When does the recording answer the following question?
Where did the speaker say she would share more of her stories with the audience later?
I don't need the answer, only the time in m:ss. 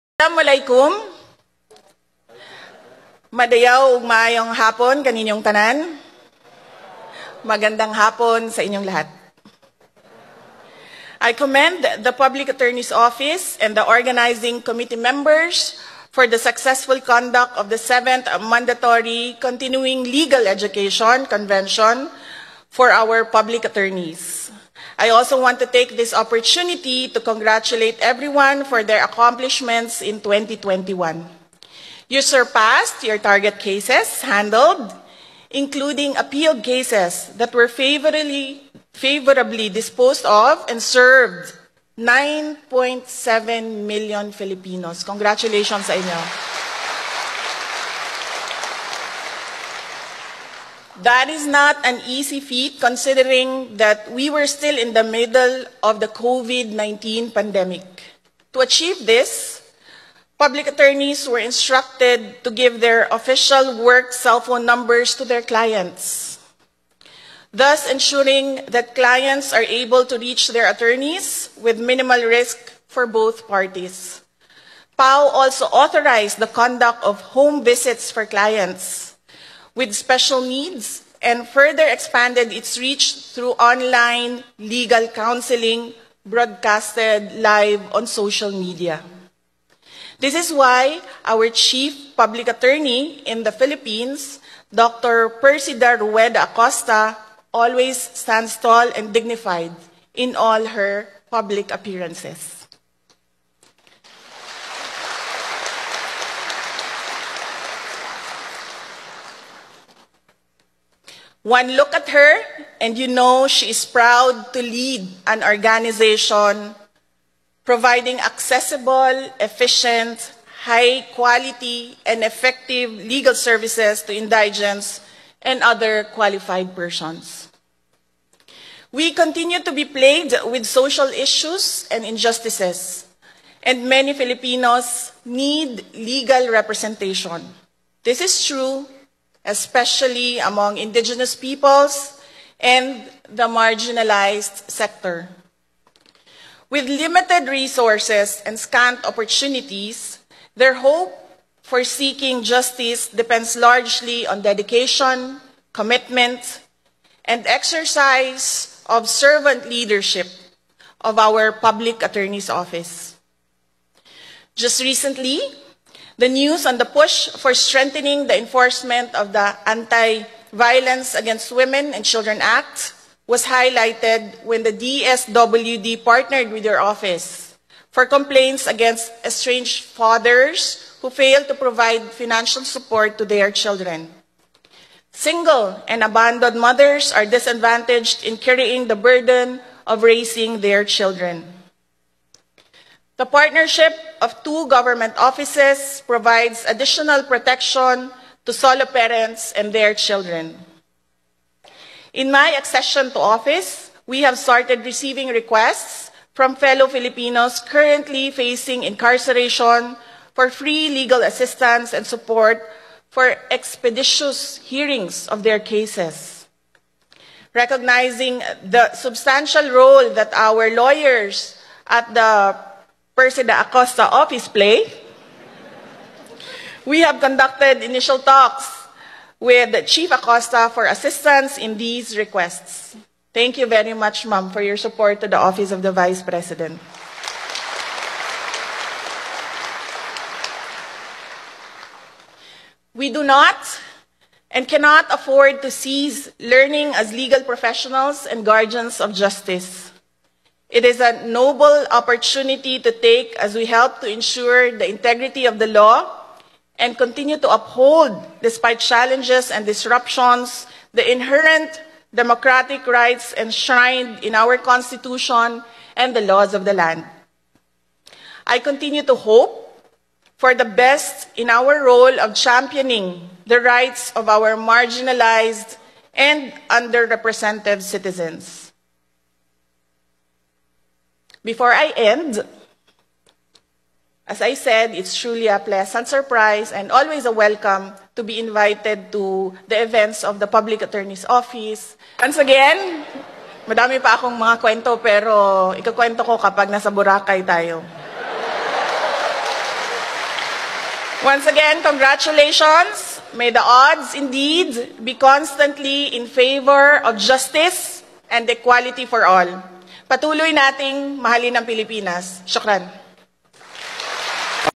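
4:56.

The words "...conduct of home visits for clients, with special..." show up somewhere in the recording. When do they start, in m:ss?
1:16.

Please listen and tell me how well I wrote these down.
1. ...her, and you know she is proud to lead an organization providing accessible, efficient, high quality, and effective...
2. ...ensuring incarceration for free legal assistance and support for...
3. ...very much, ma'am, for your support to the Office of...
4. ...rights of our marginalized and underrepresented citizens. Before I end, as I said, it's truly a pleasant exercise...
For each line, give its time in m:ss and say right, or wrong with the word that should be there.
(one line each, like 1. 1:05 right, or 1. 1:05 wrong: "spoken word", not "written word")
1. 1:52 right
2. 3:28 wrong: "facing", not "ensuring"
3. 3:53 right
4. 4:33 wrong: "surprise", not "exercise".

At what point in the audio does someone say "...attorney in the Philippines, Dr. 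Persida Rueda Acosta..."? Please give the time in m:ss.
1:32.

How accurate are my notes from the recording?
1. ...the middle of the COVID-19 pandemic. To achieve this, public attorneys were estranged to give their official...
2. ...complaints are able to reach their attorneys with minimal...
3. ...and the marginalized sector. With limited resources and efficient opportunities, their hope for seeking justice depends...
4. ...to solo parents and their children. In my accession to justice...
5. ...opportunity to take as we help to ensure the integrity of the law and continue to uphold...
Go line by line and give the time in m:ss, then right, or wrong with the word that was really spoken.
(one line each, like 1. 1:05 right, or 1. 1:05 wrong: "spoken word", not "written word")
1. 0:54 wrong: "instructed", not "estranged"
2. 1:08 wrong: "clients", not "complaints"
3. 2:22 wrong: "scant", not "efficient"
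4. 3:18 wrong: "office", not "justice"
5. 4:11 right.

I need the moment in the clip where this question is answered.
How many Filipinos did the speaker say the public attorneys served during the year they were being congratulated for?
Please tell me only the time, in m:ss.
0:41.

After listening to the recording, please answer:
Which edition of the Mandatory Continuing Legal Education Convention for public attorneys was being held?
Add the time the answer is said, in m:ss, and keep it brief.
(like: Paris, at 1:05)
7th, at 0:17.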